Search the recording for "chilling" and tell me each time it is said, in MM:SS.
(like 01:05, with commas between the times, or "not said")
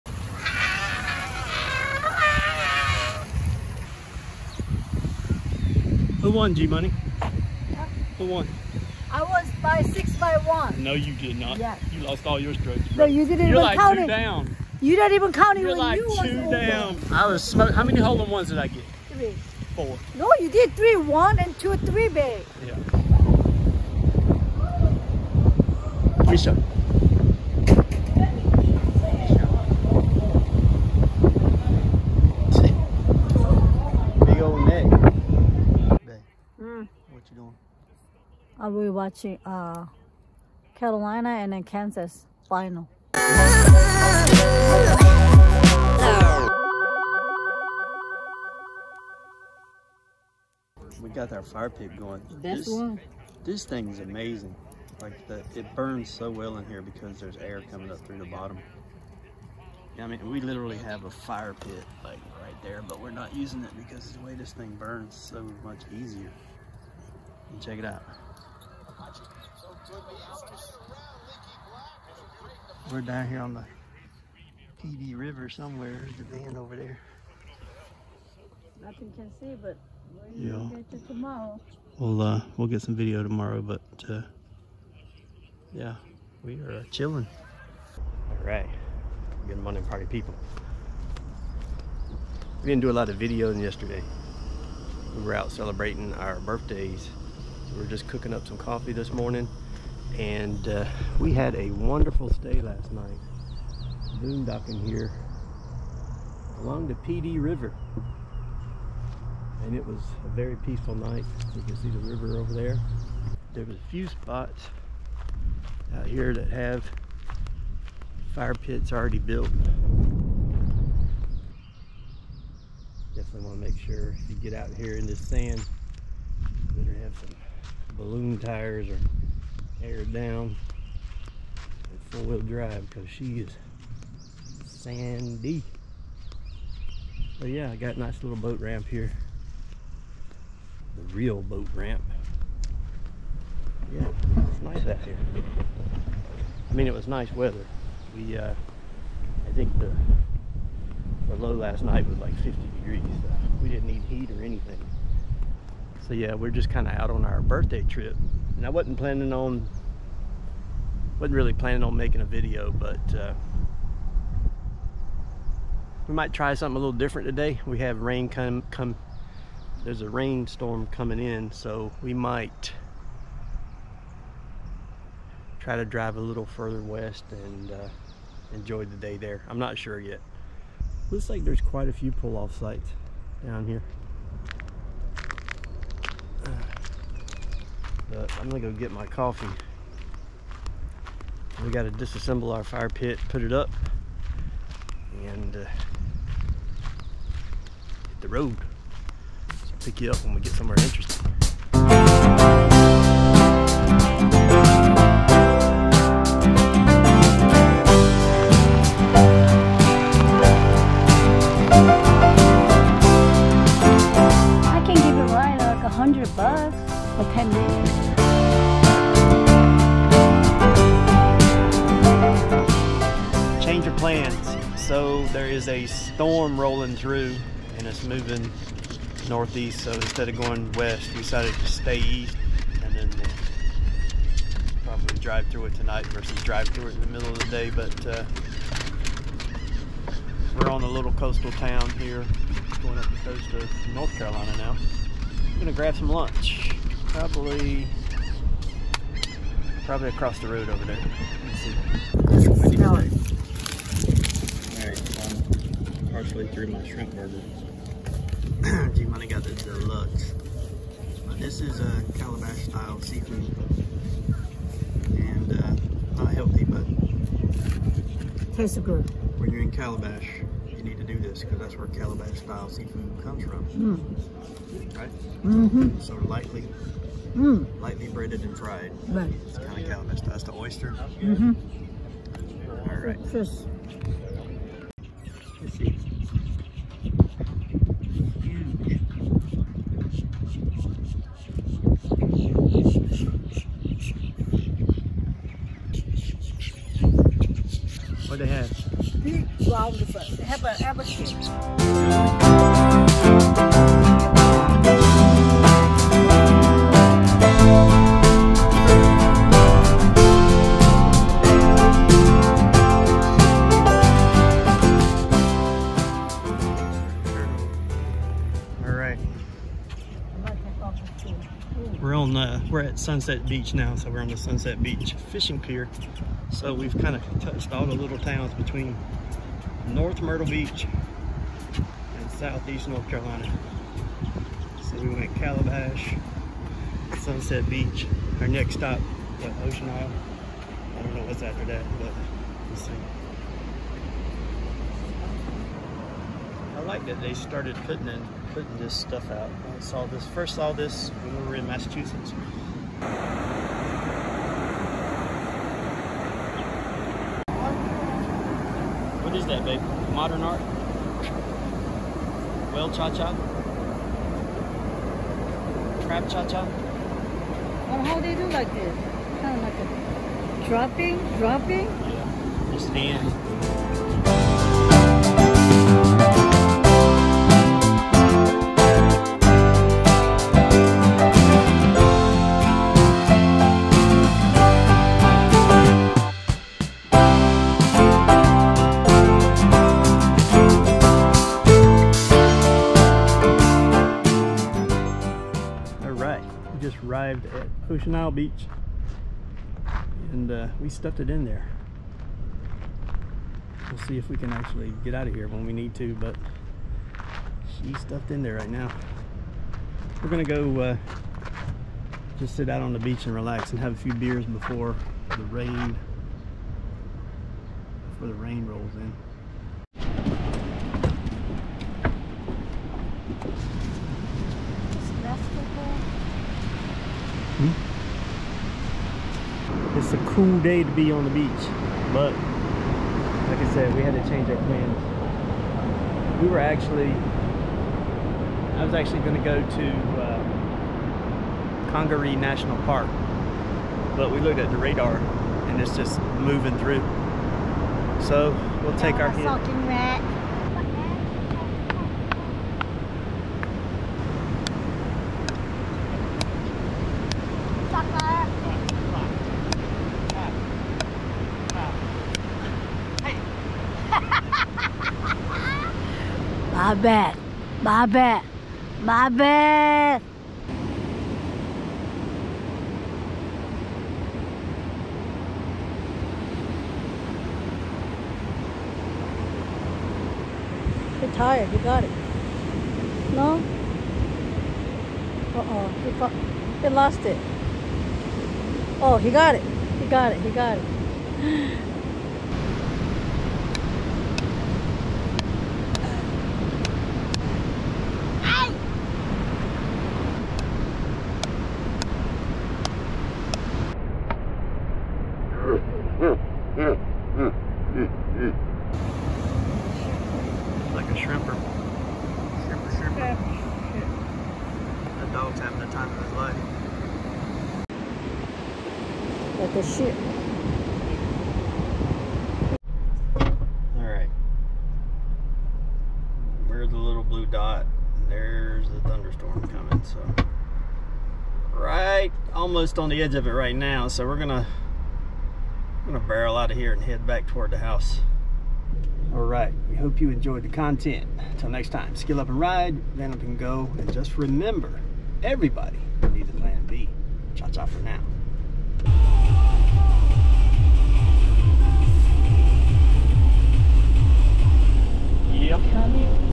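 01:26.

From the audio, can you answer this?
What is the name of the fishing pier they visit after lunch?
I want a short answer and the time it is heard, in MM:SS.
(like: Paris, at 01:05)
Sunset Beach Fishing Pier, at 05:24.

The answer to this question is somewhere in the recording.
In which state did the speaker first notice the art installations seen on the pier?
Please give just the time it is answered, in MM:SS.
05:51.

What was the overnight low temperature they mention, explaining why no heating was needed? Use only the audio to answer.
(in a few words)
50 degrees.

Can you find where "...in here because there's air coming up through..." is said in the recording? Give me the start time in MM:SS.
00:56.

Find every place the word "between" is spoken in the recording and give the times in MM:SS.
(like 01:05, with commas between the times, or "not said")
05:28.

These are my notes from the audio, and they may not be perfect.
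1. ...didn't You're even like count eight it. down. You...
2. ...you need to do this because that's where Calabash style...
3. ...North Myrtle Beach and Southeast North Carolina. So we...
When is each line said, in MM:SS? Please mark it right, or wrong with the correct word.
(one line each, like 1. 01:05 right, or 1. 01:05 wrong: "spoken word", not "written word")
1. 00:13 wrong: "two", not "eight"
2. 04:30 right
3. 05:29 right.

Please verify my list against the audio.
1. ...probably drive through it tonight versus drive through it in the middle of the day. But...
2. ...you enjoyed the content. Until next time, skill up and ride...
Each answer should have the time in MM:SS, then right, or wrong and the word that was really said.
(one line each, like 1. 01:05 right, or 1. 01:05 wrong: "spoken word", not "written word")
1. 03:54 right
2. 09:00 right.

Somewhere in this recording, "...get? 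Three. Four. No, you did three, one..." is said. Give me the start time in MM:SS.
00:18.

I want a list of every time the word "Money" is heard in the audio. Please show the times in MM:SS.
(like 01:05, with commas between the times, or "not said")
00:06, 04:19.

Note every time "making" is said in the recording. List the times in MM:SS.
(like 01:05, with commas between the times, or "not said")
02:41.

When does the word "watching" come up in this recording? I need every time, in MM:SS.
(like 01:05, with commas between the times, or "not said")
00:38.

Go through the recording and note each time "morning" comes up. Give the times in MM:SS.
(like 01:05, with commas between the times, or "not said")
01:29, 01:39.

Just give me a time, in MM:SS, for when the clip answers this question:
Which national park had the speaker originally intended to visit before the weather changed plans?
07:21.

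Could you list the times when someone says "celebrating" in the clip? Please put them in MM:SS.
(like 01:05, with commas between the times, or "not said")
01:35.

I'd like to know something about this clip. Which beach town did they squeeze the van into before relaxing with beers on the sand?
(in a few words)
Ocean Isle Beach.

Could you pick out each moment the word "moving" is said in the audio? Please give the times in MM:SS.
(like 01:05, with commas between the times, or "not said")
03:48, 07:26.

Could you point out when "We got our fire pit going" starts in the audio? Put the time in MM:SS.
00:51.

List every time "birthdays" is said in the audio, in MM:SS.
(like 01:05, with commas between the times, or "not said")
01:36, 02:37.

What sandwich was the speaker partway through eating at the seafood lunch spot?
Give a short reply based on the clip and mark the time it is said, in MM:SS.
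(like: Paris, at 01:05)
Shrimp burger, at 04:16.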